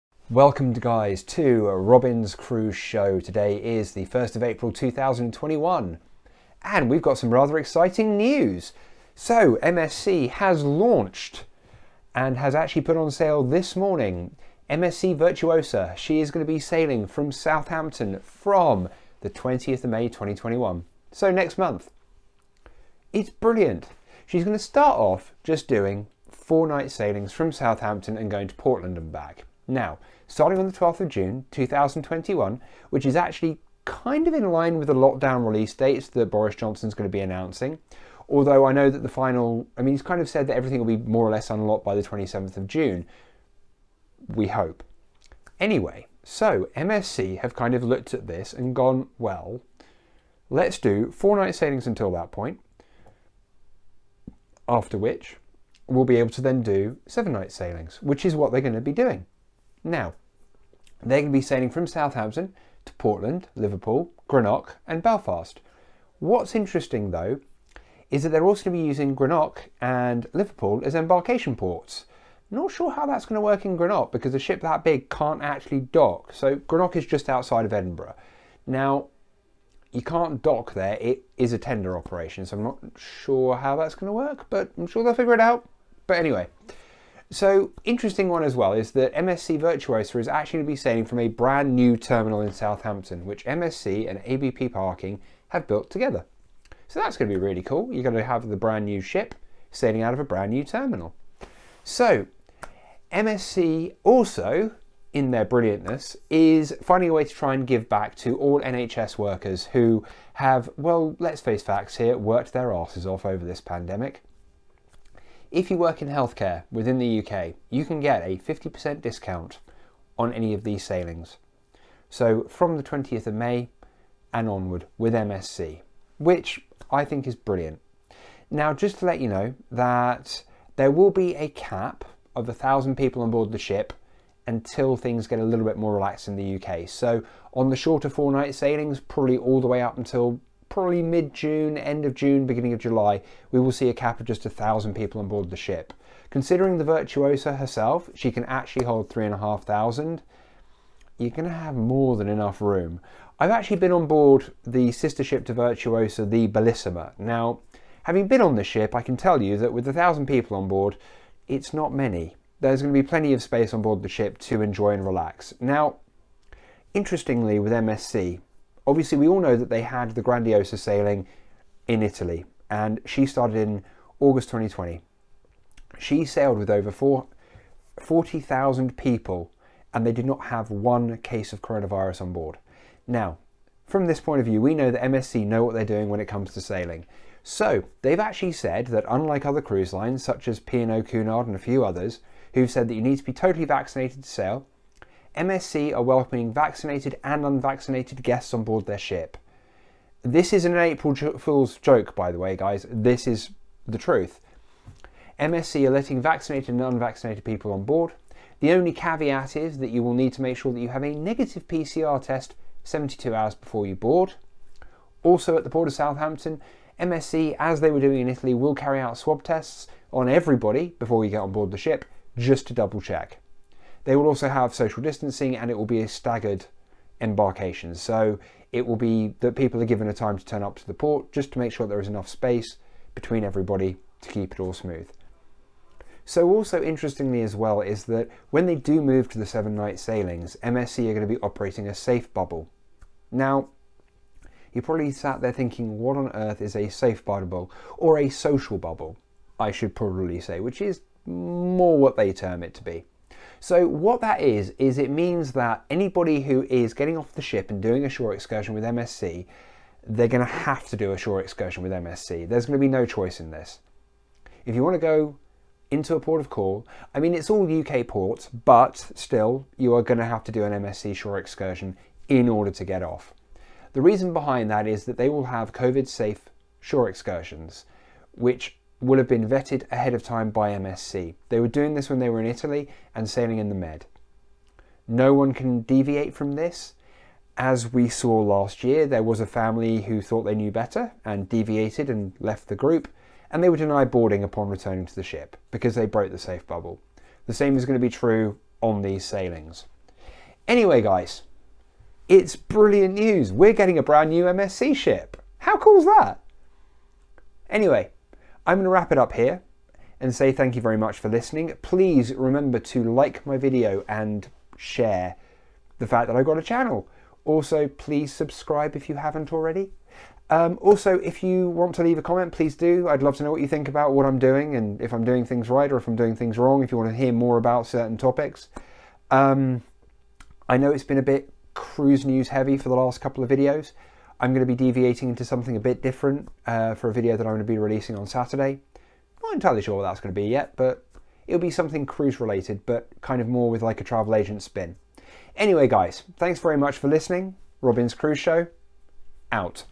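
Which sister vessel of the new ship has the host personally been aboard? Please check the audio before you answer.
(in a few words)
Bellissima.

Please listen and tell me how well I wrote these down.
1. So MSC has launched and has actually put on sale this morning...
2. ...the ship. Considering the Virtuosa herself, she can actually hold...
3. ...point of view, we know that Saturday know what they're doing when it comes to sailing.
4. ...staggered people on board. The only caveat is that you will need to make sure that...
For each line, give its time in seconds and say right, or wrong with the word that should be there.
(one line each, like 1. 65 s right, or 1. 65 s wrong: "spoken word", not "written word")
1. 9 s right
2. 145 s right
3. 184 s wrong: "MSC", not "Saturday"
4. 206 s wrong: "unvaccinated", not "staggered".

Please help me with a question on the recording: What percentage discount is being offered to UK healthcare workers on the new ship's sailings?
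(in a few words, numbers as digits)
50%.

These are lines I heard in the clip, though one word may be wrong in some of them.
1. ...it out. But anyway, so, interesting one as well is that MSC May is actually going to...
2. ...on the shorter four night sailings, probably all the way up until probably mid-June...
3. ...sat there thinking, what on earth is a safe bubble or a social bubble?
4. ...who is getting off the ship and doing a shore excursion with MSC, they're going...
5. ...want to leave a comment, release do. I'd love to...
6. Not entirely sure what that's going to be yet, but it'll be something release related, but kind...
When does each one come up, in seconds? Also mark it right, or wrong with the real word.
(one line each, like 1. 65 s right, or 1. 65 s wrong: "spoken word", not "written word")
1. 85 s wrong: "Virtuosa", not "May"
2. 137 s right
3. 245 s right
4. 256 s right
5. 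321 s wrong: "please", not "release"
6. 339 s wrong: "cruise", not "release".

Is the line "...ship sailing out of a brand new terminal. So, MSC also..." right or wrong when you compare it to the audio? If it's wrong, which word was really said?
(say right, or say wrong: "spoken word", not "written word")
right.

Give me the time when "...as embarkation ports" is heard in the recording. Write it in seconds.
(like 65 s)
70 s.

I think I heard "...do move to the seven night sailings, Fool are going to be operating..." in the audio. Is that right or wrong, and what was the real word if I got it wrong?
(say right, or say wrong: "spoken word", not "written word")
wrong: "MSC", not "Fool".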